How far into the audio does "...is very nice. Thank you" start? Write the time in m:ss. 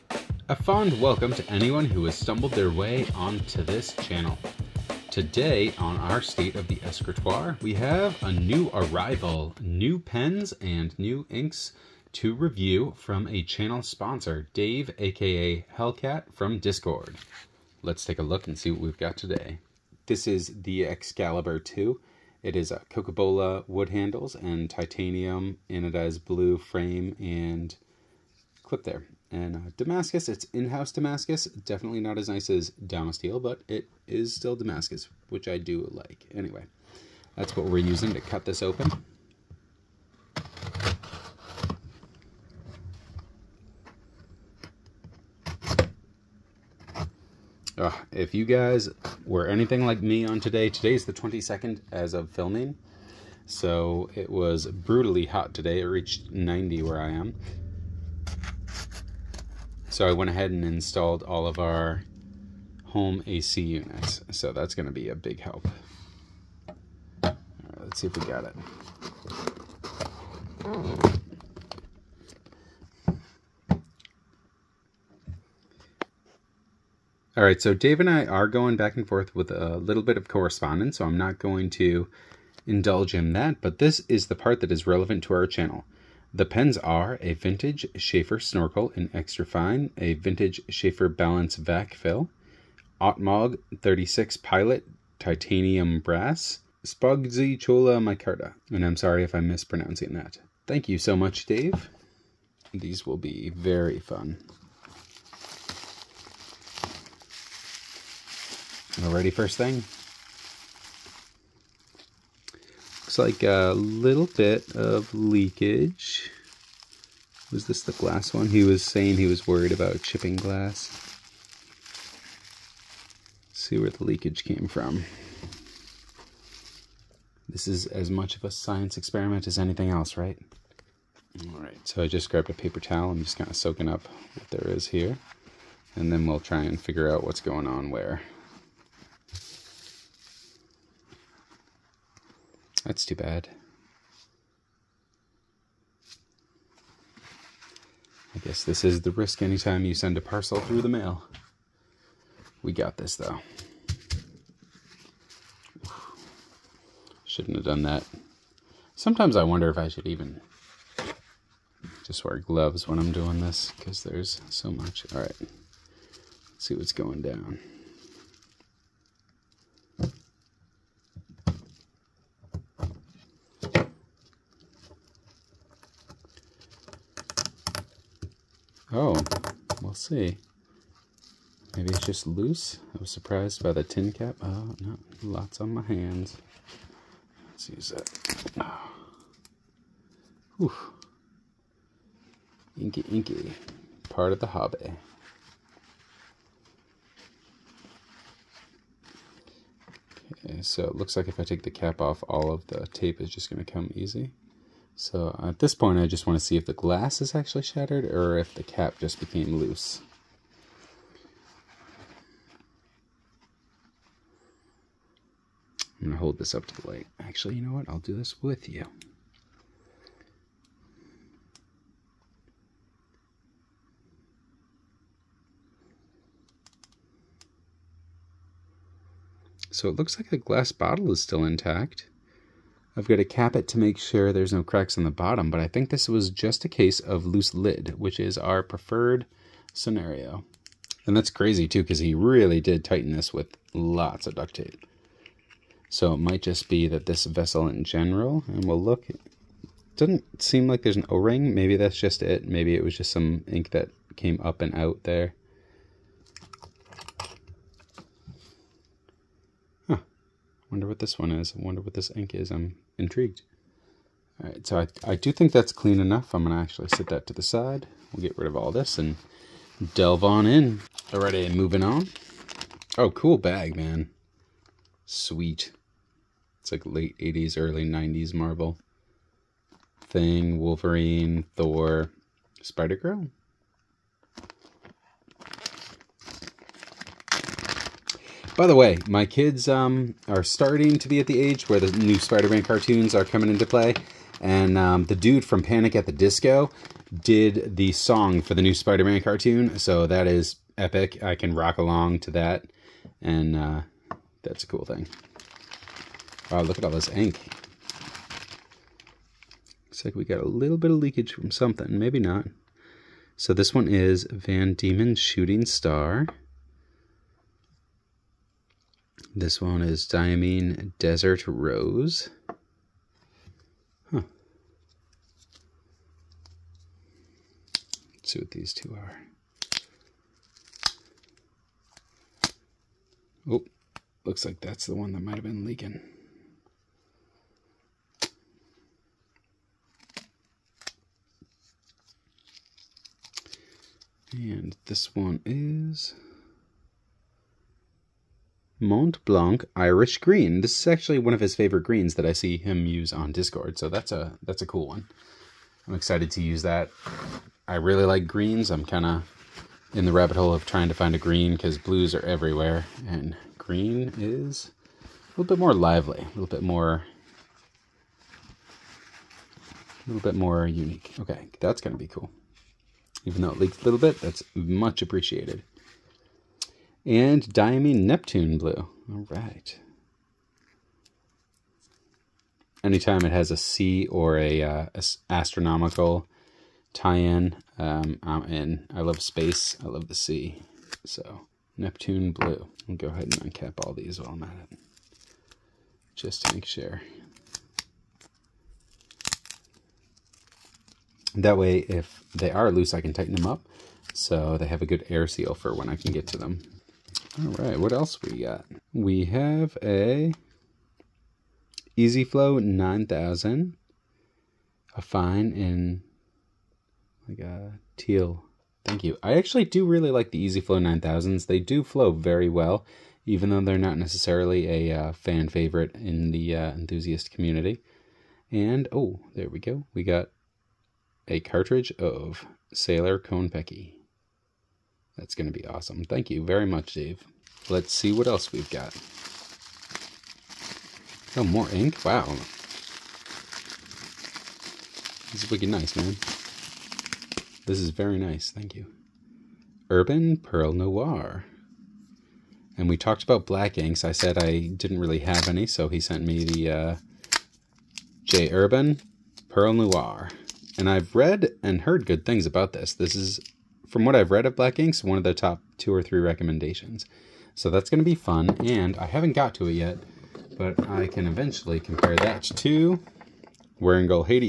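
7:27.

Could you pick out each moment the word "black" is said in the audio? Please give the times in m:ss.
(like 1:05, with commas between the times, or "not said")
7:33, 7:44.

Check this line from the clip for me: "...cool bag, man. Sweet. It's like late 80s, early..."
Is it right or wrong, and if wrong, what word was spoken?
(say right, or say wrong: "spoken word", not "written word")
right.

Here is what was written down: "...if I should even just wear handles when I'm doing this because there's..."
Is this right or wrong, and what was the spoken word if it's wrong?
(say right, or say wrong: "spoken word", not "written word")
wrong: "gloves", not "handles".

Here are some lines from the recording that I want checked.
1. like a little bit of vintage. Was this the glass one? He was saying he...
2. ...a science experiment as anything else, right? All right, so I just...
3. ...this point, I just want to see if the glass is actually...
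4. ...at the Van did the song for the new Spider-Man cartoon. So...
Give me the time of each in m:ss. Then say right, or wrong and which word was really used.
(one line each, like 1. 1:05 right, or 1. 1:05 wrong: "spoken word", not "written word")
1. 1:53 wrong: "leakage", not "vintage"
2. 2:08 right
3. 3:25 right
4. 4:55 wrong: "Disco", not "Van".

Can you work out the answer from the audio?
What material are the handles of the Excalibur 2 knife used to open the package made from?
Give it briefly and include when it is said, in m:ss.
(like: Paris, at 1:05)
Coca-Cola wood, at 0:22.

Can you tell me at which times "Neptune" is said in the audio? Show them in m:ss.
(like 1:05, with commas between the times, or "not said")
6:18, 6:31.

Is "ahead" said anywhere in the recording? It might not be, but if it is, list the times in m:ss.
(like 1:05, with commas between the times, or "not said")
1:00, 6:33.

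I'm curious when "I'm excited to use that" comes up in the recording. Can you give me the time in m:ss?
5:55.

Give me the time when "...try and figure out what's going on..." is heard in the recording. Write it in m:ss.
2:16.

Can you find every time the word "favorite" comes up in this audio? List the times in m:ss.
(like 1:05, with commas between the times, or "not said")
5:51, 7:05.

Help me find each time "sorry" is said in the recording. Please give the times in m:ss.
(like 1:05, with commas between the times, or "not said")
1:38.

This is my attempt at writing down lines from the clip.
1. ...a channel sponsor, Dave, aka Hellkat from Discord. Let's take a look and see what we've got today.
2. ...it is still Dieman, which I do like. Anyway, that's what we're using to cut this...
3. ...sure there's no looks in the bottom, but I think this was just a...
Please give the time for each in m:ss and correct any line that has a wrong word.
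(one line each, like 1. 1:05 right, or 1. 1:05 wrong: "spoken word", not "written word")
1. 0:13 right
2. 0:33 wrong: "Damascus", not "Dieman"
3. 3:53 wrong: "cracks", not "looks".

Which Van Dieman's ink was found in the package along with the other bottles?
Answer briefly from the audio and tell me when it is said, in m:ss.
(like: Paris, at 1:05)
Shooting Star, at 5:15.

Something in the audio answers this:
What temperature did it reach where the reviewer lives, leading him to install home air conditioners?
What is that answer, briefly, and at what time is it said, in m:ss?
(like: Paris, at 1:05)
90, at 0:56.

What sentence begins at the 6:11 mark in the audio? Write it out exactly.
Okay, that's going to be cool.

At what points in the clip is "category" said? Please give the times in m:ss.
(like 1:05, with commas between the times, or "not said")
not said.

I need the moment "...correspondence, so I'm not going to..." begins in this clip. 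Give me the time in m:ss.
1:20.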